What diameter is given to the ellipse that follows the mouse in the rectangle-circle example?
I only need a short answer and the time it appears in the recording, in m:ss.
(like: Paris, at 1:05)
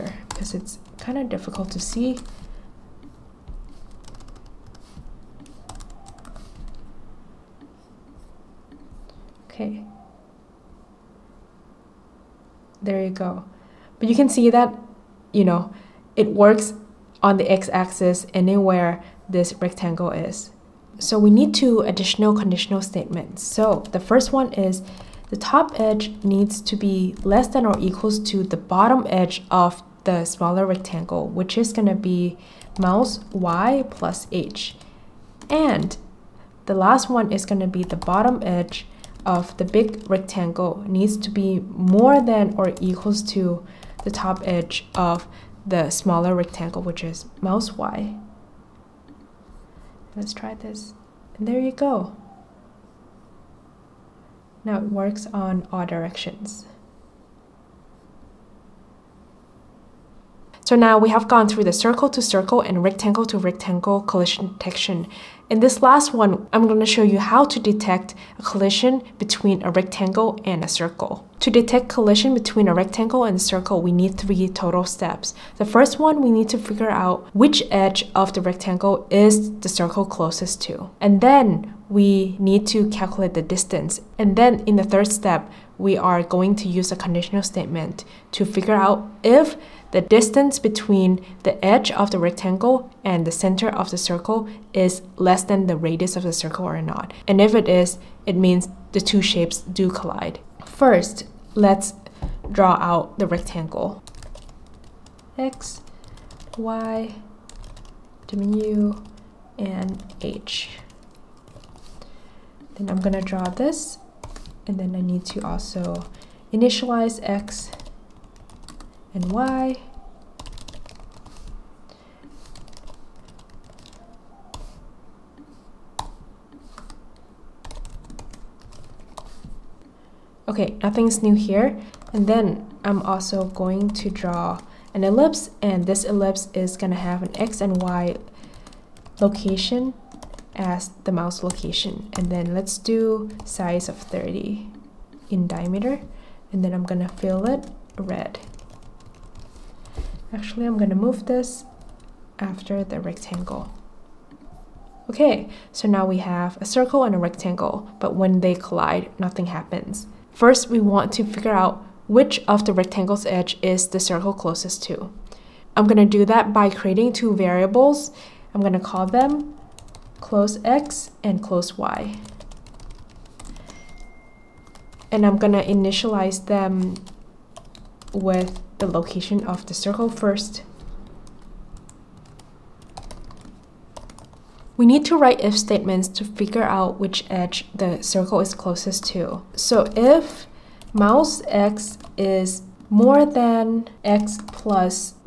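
30, at 2:23.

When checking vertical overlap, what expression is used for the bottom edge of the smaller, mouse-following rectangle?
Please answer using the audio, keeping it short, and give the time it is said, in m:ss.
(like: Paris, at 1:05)
mouse y plus h, at 0:32.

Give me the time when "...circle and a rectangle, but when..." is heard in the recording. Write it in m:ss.
2:36.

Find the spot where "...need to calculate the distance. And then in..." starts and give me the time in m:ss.
1:22.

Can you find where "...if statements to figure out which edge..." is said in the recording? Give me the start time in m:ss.
3:05.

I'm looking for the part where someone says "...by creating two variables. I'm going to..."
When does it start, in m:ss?
2:46.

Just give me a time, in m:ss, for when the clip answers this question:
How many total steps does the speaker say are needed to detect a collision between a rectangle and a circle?
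1:14.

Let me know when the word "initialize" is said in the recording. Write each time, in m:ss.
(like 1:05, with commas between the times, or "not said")
1:56, 2:55.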